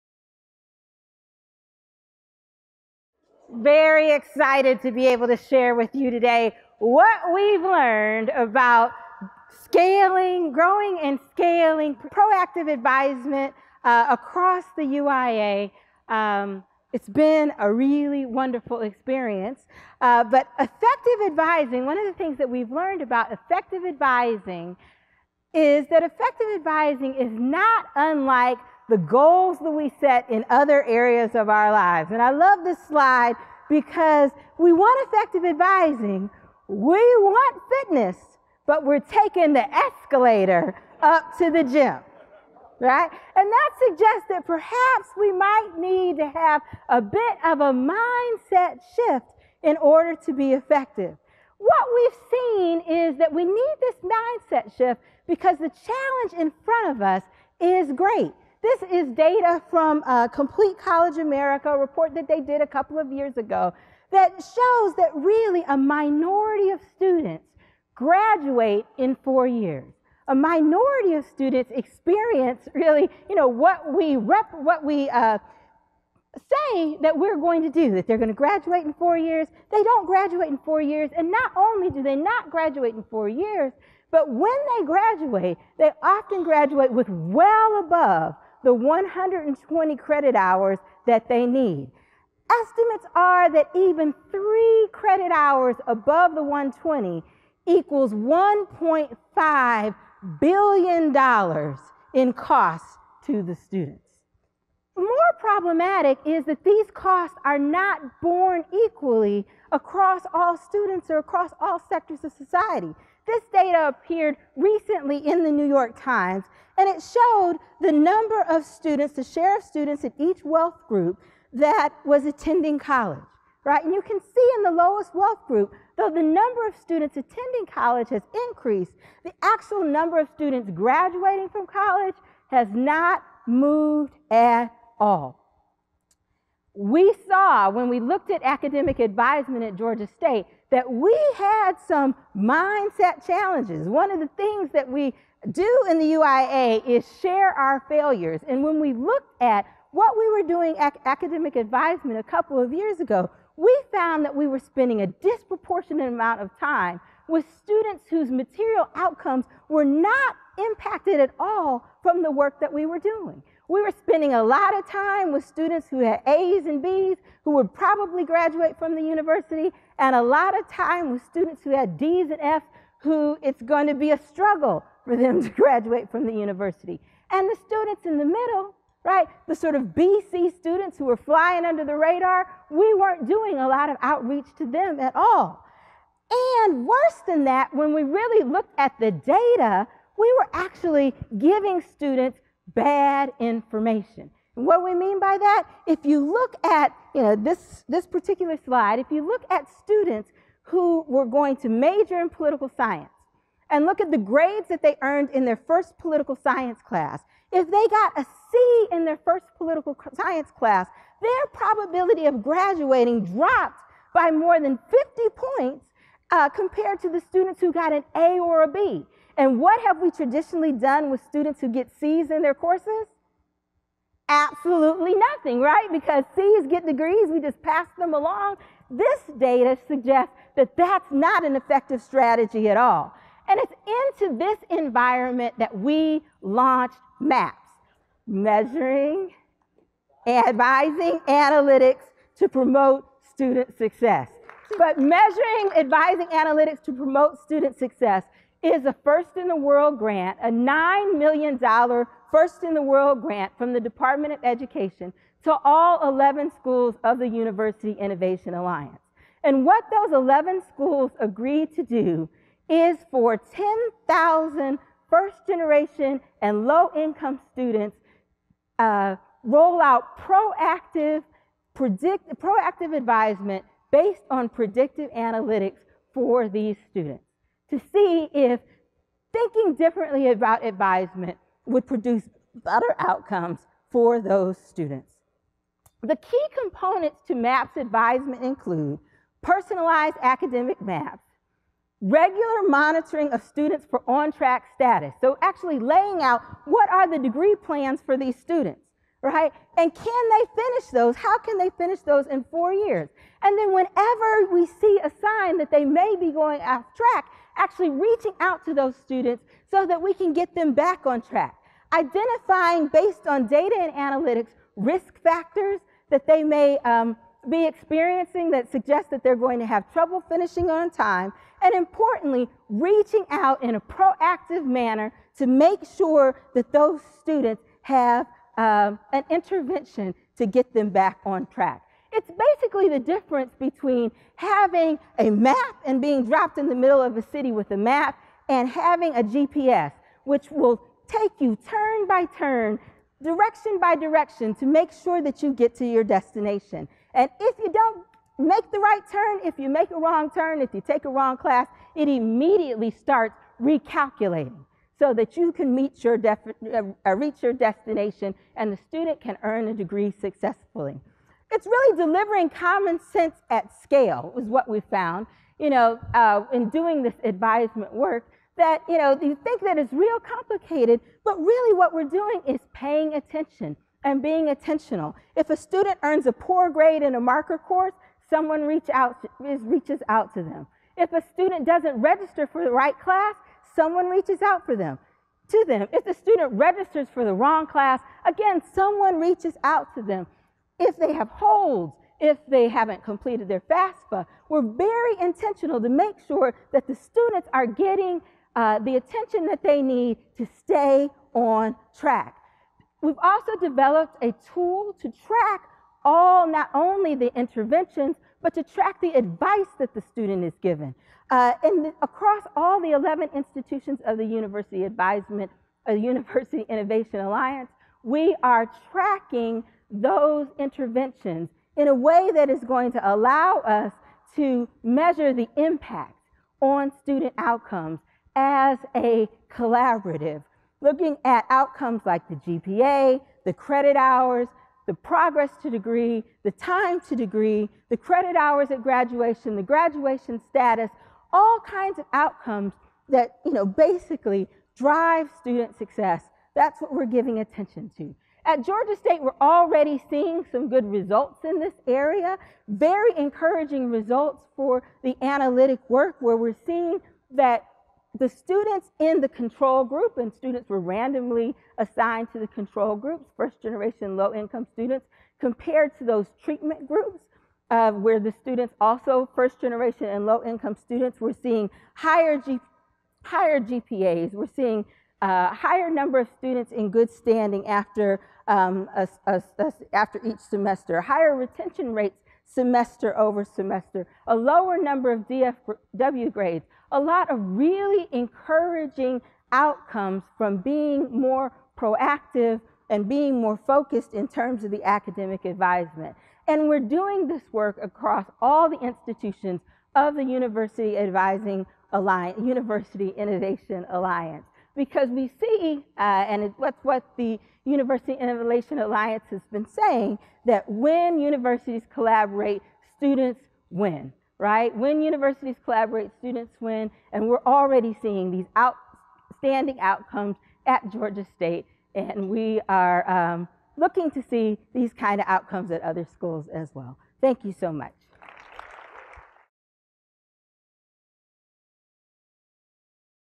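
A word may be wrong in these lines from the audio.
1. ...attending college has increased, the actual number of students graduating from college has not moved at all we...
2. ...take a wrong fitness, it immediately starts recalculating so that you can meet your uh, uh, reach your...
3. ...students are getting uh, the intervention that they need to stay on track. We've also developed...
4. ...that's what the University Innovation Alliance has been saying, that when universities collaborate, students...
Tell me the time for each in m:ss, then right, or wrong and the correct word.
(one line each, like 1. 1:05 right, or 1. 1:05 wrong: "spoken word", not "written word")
1. 2:07 right
2. 5:50 wrong: "class", not "fitness"
3. 6:36 wrong: "attention", not "intervention"
4. 8:26 right.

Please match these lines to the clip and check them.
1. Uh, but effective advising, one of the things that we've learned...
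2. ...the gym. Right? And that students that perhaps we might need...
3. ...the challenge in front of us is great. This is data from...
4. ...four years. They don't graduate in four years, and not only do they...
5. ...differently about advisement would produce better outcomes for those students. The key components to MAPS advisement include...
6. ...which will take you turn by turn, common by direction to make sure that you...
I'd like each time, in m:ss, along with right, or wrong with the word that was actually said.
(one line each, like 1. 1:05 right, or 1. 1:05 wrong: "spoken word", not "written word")
1. 0:19 right
2. 0:41 wrong: "suggests", not "students"
3. 0:55 right
4. 1:18 right
5. 4:39 right
6. 5:40 wrong: "direction", not "common".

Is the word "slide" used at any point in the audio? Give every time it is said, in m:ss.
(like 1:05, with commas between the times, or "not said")
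0:32, 3:18.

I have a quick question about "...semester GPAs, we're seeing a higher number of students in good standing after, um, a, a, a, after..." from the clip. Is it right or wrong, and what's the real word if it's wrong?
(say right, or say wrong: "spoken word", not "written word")
wrong: "higher", not "semester".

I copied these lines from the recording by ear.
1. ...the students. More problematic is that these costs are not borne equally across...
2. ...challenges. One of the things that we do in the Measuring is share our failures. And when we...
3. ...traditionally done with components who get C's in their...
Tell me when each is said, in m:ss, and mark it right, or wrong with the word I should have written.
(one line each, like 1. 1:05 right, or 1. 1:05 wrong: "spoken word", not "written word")
1. 1:43 right
2. 2:23 wrong: "UIA", not "Measuring"
3. 3:40 wrong: "students", not "components".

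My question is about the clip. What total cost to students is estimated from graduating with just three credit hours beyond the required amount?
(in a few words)
$1.5 billion.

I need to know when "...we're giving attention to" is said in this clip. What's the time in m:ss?
7:26.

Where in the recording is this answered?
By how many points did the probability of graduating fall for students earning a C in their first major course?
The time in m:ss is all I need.
3:34.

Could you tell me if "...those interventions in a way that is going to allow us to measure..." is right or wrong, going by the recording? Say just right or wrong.
right.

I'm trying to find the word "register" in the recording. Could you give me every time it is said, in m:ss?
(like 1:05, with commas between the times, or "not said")
6:21, 6:26.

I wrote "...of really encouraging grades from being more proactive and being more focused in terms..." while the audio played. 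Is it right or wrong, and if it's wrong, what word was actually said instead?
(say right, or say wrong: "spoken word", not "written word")
wrong: "outcomes", not "grades".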